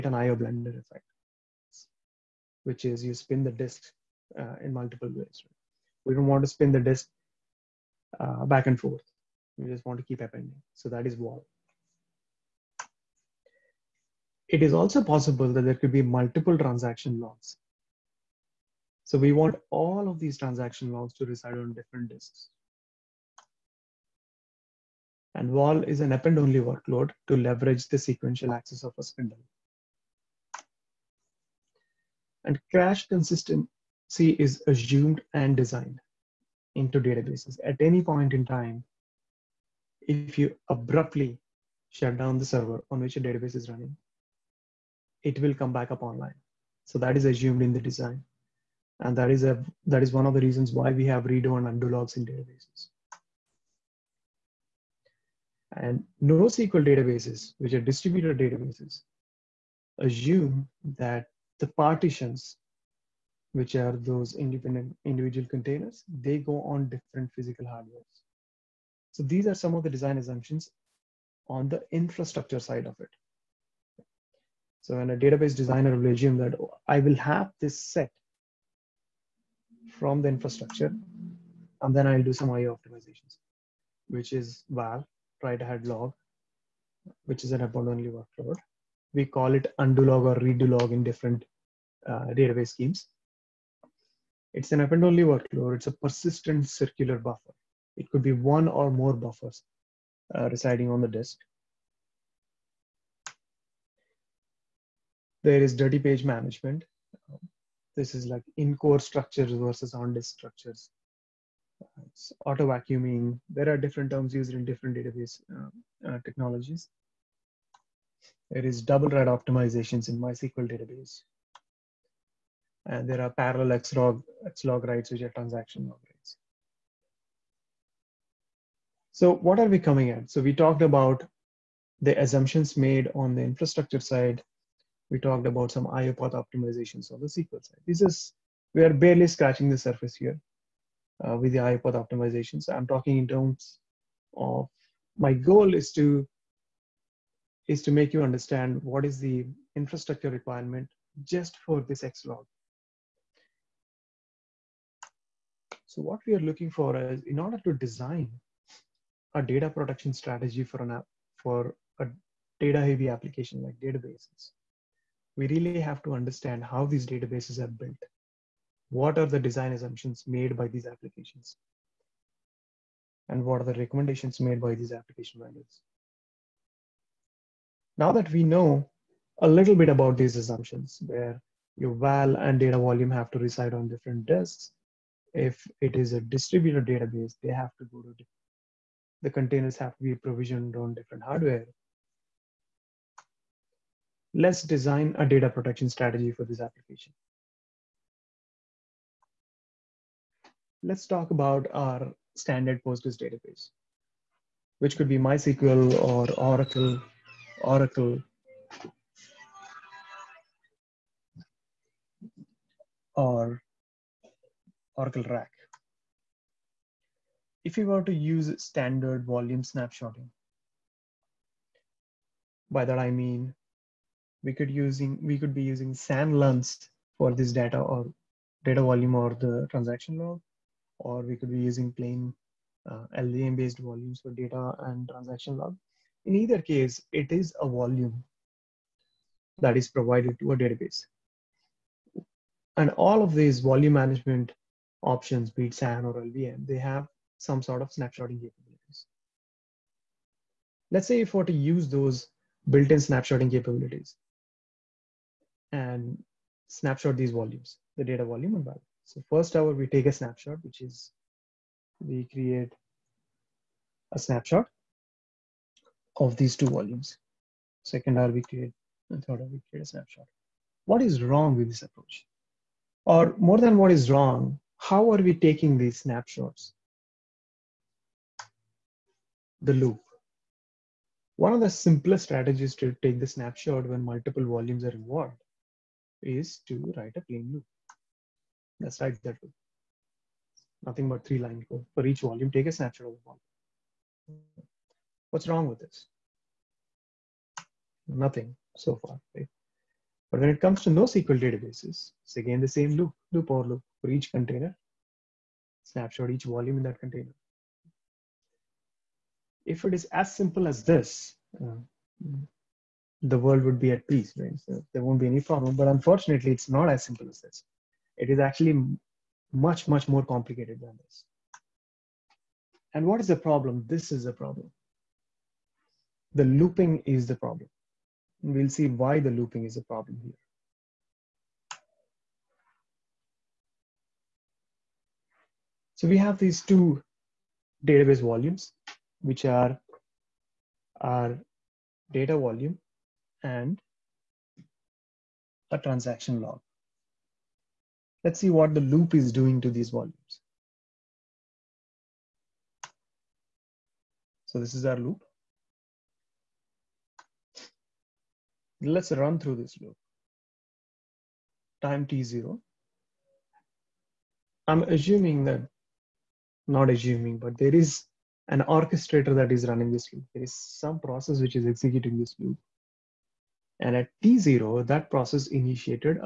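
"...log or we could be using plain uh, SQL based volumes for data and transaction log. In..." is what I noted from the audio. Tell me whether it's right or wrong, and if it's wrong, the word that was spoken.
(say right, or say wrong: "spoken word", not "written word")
wrong: "LVM", not "SQL".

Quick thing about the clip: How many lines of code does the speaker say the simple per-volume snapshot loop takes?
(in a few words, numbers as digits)
3.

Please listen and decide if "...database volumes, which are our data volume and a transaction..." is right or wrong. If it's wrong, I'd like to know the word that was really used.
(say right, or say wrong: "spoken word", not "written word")
right.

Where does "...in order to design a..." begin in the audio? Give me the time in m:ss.
2:37.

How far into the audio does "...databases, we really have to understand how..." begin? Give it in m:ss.
2:43.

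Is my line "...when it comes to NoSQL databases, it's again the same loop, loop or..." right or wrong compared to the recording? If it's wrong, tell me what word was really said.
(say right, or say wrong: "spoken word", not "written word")
right.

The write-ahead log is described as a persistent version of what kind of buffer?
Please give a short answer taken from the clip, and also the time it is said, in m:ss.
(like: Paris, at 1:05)
circular buffer, at 1:36.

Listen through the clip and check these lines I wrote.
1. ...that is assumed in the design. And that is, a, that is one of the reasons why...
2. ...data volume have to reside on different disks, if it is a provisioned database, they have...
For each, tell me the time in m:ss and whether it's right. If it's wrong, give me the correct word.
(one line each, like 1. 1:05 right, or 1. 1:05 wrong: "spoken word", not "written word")
1. 0:46 right
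2. 3:02 wrong: "distributed", not "provisioned".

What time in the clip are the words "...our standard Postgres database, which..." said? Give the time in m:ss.
3:21.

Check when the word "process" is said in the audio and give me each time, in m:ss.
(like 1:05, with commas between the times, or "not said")
6:10, 6:15.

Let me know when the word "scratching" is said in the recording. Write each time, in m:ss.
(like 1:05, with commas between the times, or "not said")
2:19.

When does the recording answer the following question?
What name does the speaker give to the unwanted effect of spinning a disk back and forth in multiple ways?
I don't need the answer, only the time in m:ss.
0:00.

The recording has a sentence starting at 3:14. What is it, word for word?
Let's design a data protection strategy for this application.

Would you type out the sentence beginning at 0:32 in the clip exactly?
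And crash consistency is assumed and designed into databases.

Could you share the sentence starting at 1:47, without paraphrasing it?
This is like in-core structures versus on-disk structures it's auto vacuuming.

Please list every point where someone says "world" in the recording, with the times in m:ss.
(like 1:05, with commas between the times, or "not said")
5:13.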